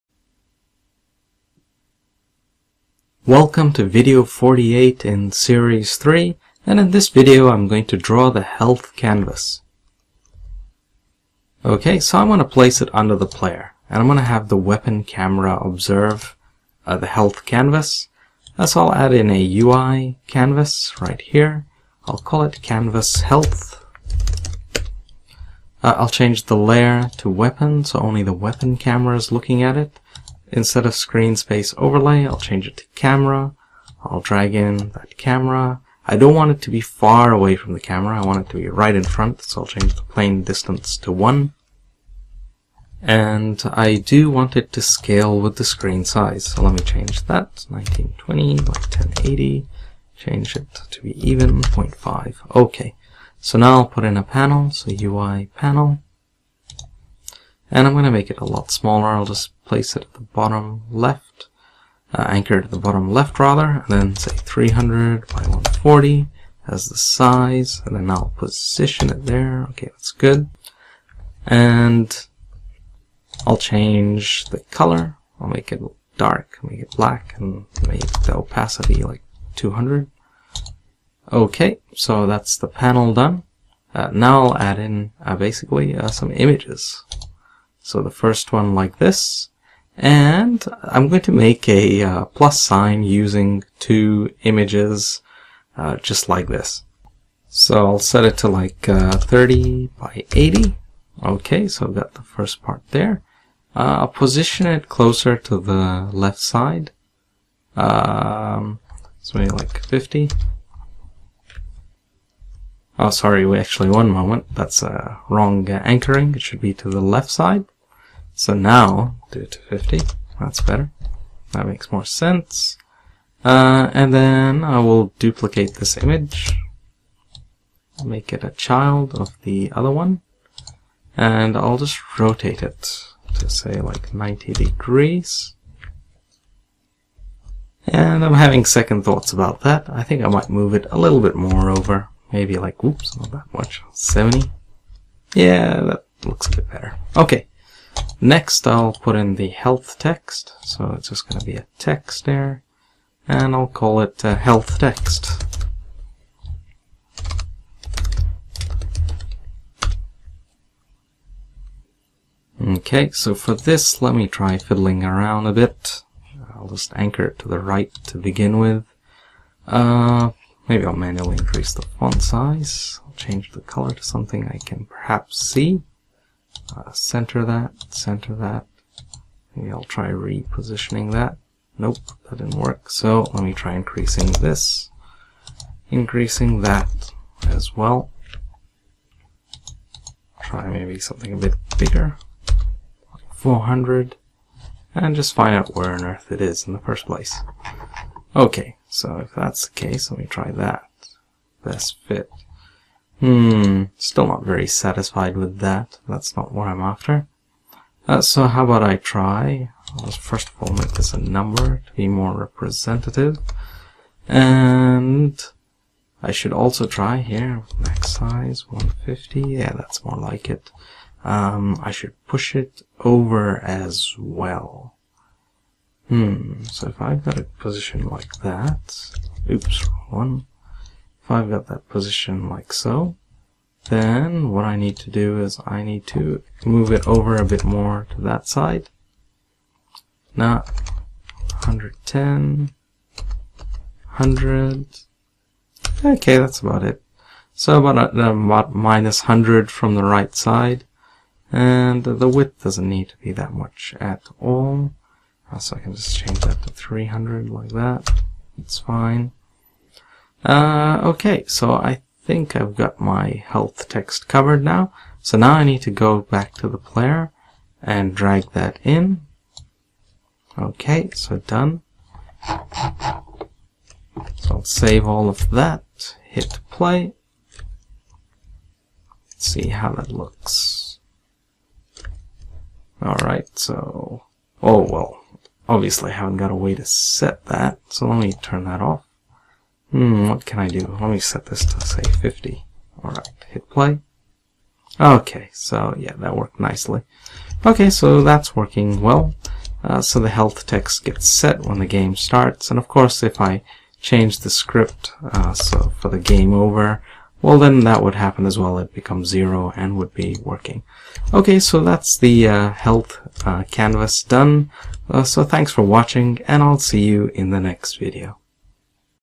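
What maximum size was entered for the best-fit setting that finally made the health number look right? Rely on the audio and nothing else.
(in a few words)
150.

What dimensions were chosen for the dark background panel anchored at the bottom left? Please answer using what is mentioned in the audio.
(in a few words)
300 by 140.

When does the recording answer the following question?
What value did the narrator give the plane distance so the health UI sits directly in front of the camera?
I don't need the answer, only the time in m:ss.
0:41.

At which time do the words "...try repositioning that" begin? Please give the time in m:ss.
2:59.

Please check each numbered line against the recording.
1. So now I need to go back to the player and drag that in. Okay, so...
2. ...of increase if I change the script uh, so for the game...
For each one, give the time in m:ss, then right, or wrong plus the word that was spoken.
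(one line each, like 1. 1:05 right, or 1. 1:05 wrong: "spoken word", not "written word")
1. 4:25 right
2. 5:02 wrong: "course", not "increase".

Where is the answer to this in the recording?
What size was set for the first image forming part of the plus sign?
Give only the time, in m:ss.
1:39.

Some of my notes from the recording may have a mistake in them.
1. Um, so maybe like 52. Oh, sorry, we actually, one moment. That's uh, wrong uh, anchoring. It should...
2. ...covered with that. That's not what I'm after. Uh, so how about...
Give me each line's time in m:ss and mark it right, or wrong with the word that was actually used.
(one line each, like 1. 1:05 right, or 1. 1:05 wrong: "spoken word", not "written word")
1. 1:47 wrong: "50", not "52"
2. 3:24 wrong: "satisfied", not "covered".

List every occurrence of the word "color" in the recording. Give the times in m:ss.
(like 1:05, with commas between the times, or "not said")
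1:14, 2:53.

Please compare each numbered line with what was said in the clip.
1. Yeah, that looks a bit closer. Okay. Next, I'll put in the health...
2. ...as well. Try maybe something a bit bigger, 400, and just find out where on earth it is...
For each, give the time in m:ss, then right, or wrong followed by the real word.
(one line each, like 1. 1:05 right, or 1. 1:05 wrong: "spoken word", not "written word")
1. 2:25 wrong: "better", not "closer"
2. 3:07 right.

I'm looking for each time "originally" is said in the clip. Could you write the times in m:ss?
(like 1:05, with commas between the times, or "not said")
not said.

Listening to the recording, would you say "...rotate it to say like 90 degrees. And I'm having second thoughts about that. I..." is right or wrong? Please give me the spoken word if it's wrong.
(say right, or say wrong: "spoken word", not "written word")
right.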